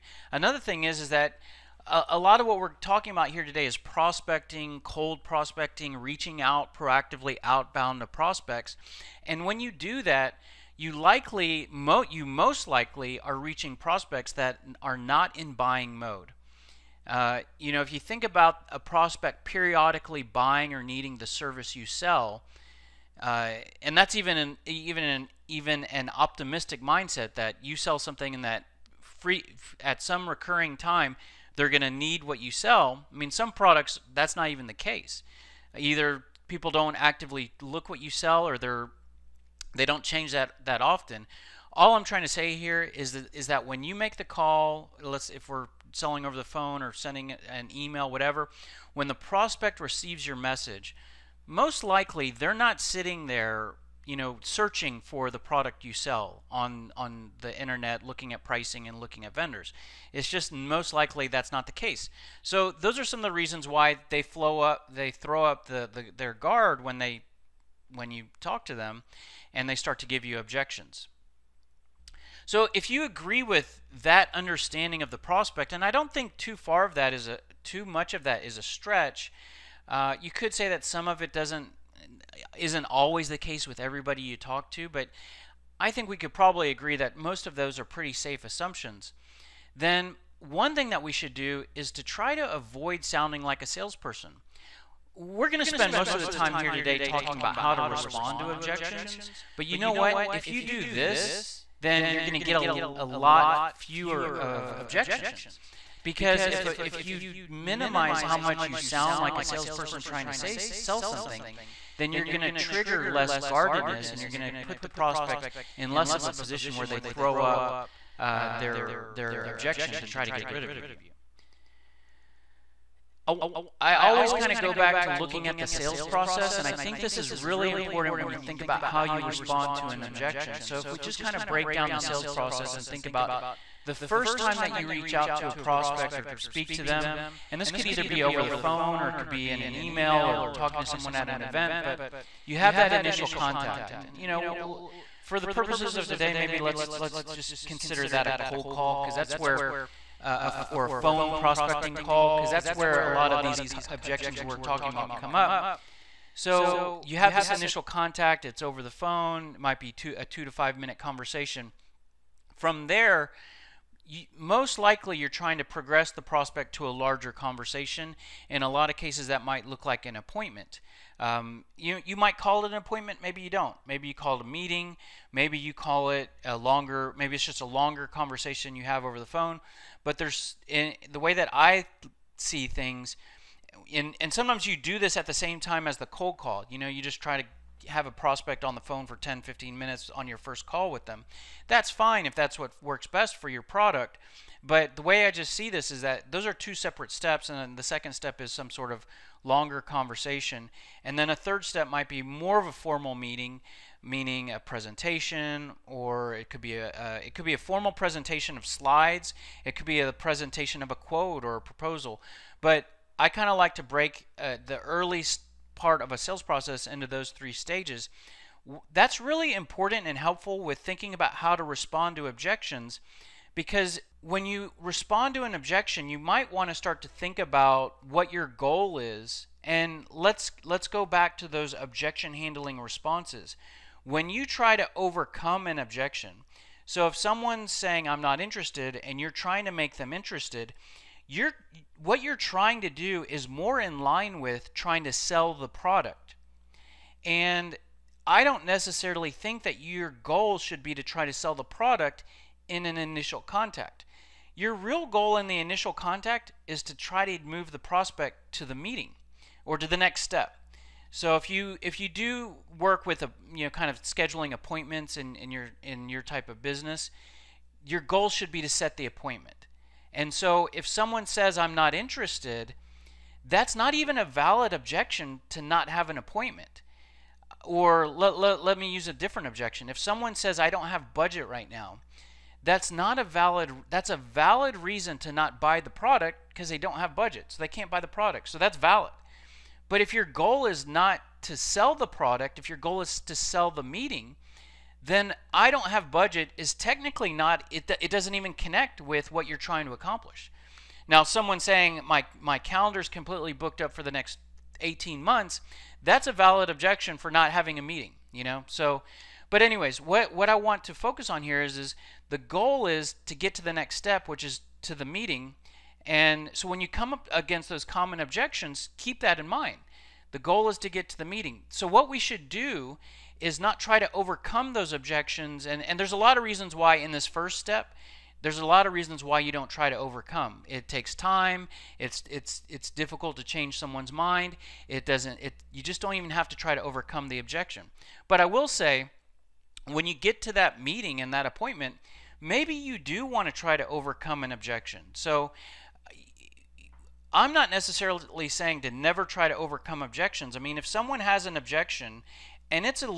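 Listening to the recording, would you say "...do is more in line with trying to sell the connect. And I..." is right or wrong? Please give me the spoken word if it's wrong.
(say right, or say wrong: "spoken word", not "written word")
wrong: "product", not "connect".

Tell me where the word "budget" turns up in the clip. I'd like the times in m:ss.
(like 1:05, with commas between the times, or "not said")
4:41, 4:47, 4:56.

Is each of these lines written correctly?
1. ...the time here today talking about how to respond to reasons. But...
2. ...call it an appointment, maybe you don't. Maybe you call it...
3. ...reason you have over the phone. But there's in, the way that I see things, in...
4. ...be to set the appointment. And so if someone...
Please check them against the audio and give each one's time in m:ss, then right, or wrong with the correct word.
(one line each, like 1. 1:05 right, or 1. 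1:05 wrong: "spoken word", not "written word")
1. 1:36 wrong: "objections", not "reasons"
2. 2:52 right
3. 2:58 wrong: "conversation", not "reason"
4. 4:28 right.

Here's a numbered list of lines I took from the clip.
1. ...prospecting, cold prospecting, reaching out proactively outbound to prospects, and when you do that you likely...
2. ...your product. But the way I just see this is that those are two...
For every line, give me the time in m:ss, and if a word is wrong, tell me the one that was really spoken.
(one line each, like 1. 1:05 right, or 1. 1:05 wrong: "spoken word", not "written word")
1. 0:03 right
2. 3:13 right.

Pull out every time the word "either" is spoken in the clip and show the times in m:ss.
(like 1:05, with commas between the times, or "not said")
0:35, 2:17.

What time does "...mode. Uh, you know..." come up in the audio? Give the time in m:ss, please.
0:15.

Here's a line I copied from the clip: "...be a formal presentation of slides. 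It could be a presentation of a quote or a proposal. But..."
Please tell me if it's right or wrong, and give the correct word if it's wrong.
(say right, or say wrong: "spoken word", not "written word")
right.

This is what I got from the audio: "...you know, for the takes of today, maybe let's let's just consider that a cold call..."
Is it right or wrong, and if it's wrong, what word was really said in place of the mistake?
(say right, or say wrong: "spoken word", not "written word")
wrong: "purposes", not "takes".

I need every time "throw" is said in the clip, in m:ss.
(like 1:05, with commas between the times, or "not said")
1:05, 1:56.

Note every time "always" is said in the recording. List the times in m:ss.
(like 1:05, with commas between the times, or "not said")
1:22, 2:03.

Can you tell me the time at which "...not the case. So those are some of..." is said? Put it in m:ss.
1:01.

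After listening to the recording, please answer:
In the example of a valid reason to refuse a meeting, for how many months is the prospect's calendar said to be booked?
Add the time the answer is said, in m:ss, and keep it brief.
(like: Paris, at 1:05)
18, at 5:04.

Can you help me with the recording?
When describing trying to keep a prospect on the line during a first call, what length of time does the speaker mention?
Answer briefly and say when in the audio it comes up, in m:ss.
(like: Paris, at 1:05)
10, 15 minutes, at 3:09.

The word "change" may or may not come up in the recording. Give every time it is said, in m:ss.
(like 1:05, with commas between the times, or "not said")
0:40, 5:33.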